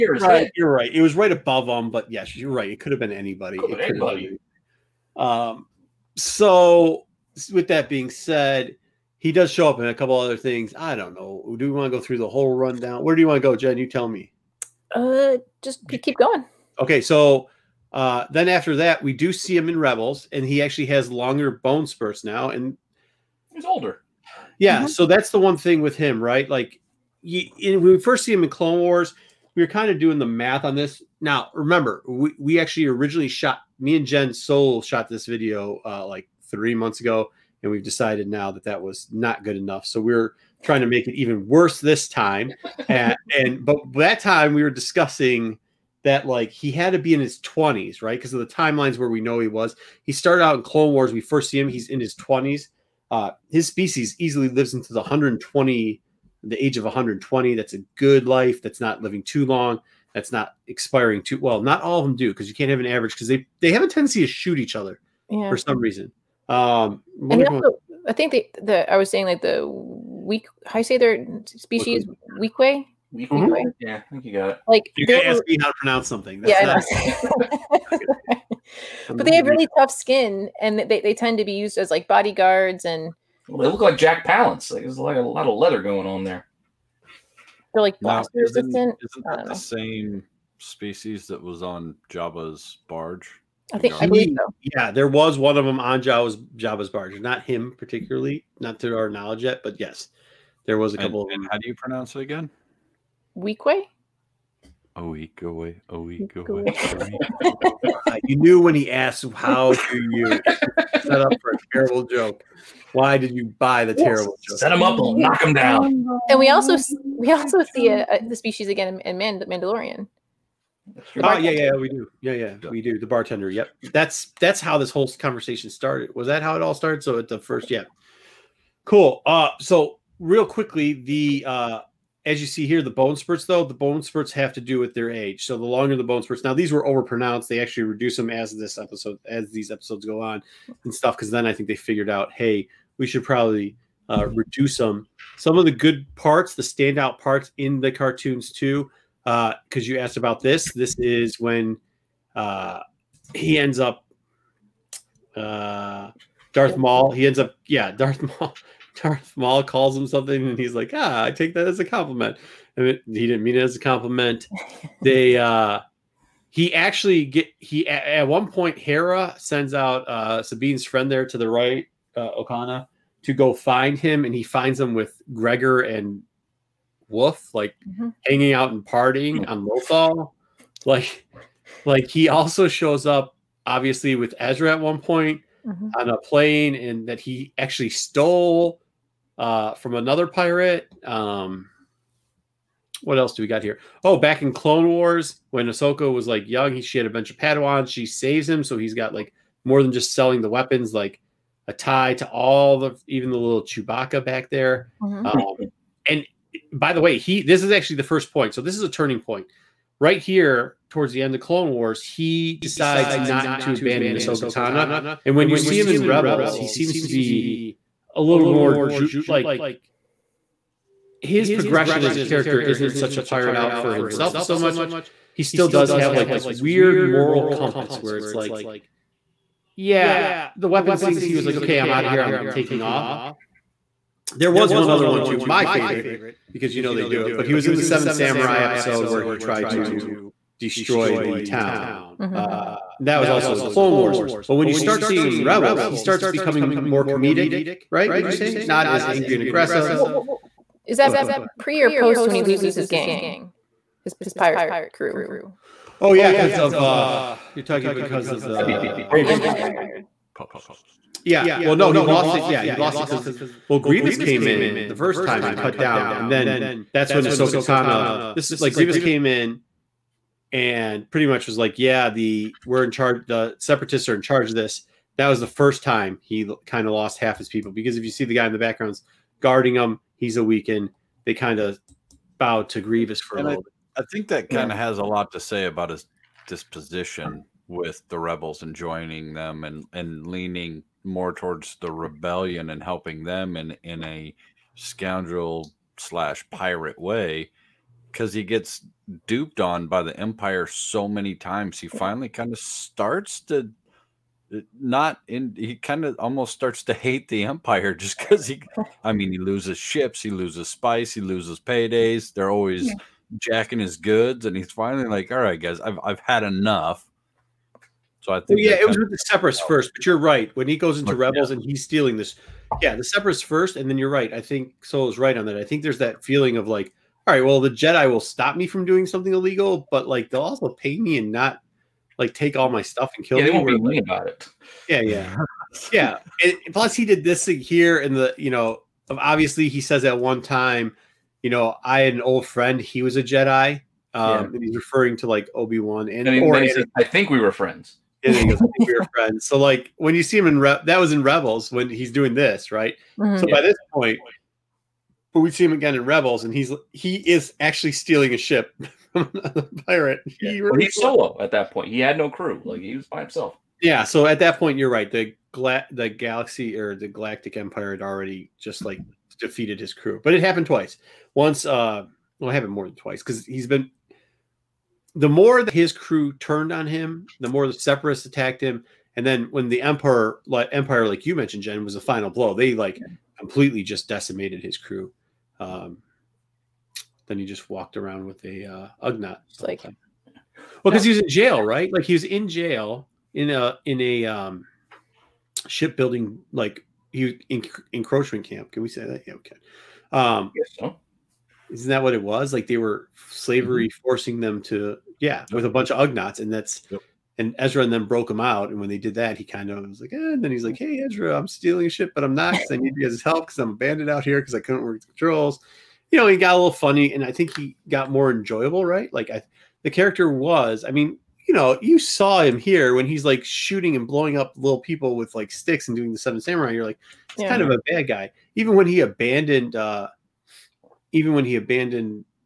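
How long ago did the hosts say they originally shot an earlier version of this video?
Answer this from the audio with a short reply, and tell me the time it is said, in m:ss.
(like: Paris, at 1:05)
3 months ago, at 0:36.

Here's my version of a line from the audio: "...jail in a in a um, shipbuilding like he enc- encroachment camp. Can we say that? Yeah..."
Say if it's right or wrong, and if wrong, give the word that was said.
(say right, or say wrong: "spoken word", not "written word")
right.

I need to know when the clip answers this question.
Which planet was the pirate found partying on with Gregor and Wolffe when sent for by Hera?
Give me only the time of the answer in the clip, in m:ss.
2:59.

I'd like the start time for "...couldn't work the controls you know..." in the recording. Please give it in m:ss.
6:54.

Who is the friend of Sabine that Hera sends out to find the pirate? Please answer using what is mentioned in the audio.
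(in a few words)
Okana.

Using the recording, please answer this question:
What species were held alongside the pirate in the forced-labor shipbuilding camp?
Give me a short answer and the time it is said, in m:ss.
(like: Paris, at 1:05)
Ugnaughts, at 6:46.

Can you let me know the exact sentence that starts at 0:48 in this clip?
Because of the timelines where we know he was.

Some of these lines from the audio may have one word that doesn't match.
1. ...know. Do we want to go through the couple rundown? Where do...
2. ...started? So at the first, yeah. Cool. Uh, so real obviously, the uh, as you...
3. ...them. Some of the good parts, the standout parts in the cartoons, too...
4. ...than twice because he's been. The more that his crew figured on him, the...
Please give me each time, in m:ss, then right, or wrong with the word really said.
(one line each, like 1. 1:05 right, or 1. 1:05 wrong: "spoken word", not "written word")
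1. 0:11 wrong: "whole", not "couple"
2. 2:06 wrong: "quickly", not "obviously"
3. 2:24 right
4. 6:12 wrong: "turned", not "figured".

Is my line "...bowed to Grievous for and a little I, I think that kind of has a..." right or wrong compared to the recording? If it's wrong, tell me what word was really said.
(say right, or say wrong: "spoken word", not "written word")
right.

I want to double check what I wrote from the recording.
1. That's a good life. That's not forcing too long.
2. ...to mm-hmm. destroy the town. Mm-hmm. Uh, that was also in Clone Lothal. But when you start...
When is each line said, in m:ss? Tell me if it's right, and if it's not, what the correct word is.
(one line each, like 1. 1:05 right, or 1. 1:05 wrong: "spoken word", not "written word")
1. 0:57 wrong: "living", not "forcing"
2. 3:59 wrong: "Wars", not "Lothal".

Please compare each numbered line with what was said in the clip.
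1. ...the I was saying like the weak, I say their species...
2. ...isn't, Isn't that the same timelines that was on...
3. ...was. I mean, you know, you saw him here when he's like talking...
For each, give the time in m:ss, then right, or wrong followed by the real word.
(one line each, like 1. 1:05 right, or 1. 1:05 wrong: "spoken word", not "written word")
1. 1:08 right
2. 1:28 wrong: "species", not "timelines"
3. 7:00 wrong: "shooting", not "talking".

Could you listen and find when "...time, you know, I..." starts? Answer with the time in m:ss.
5:40.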